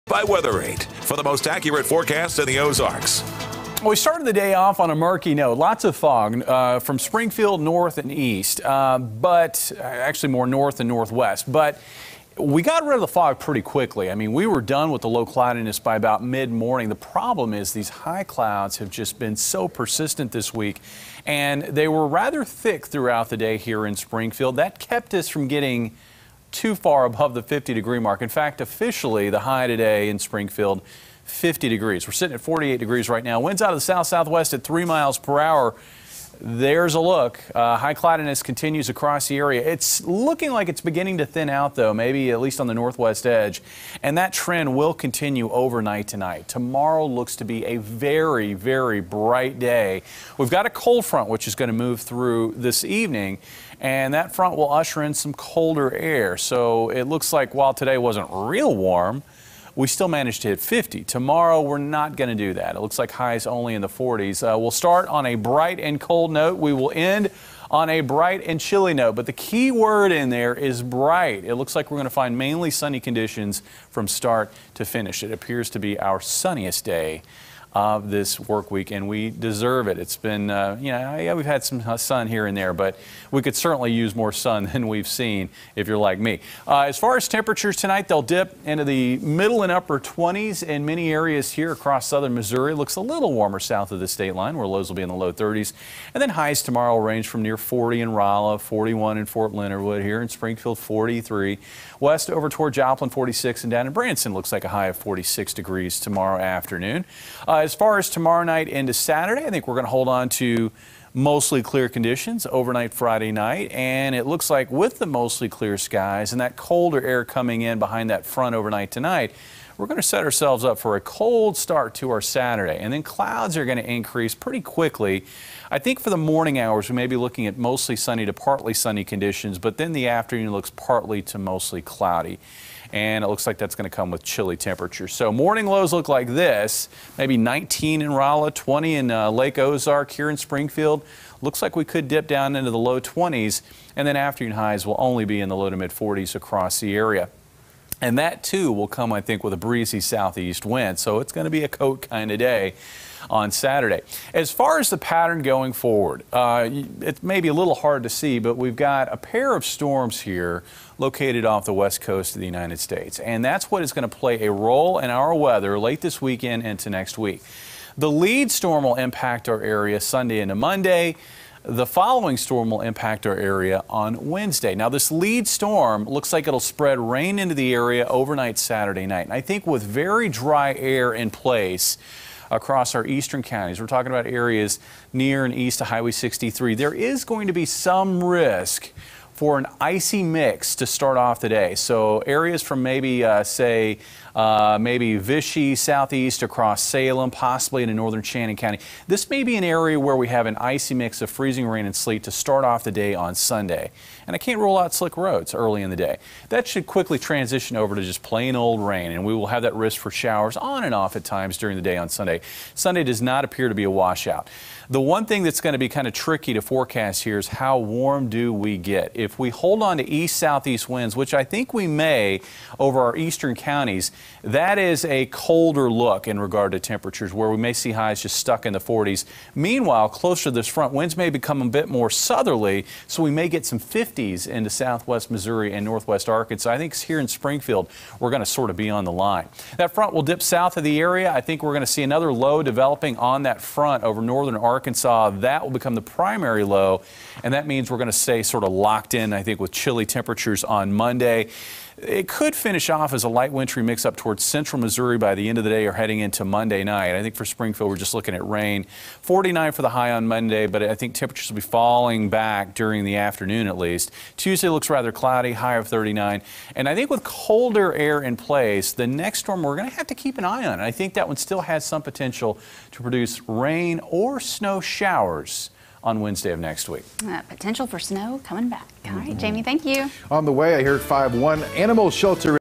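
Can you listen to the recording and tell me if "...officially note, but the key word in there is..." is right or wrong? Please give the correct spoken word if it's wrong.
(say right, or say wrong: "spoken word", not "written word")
wrong: "chilly", not "officially".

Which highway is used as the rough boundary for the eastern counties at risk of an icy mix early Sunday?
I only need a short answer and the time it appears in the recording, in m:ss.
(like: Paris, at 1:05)
Highway 63, at 3:05.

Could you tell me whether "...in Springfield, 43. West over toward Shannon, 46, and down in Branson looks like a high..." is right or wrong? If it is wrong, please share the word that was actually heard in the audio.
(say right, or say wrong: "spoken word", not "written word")
wrong: "Joplin", not "Shannon".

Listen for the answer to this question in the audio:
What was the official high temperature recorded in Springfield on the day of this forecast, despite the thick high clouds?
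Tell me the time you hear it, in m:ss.
0:31.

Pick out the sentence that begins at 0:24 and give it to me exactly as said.
That kept us from getting too far above the 50 degree mark.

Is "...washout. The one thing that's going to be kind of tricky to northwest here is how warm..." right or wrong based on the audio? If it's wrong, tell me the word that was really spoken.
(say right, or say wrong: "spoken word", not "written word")
wrong: "forecast", not "northwest".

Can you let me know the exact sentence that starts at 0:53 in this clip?
And that front will usher in some colder air.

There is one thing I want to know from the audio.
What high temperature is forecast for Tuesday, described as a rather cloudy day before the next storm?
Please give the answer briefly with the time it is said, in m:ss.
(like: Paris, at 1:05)
39, at 4:25.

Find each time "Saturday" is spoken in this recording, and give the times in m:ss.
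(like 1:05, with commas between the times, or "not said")
1:48, 2:02, 2:33, 2:58.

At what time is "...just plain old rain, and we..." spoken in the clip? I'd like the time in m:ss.
3:28.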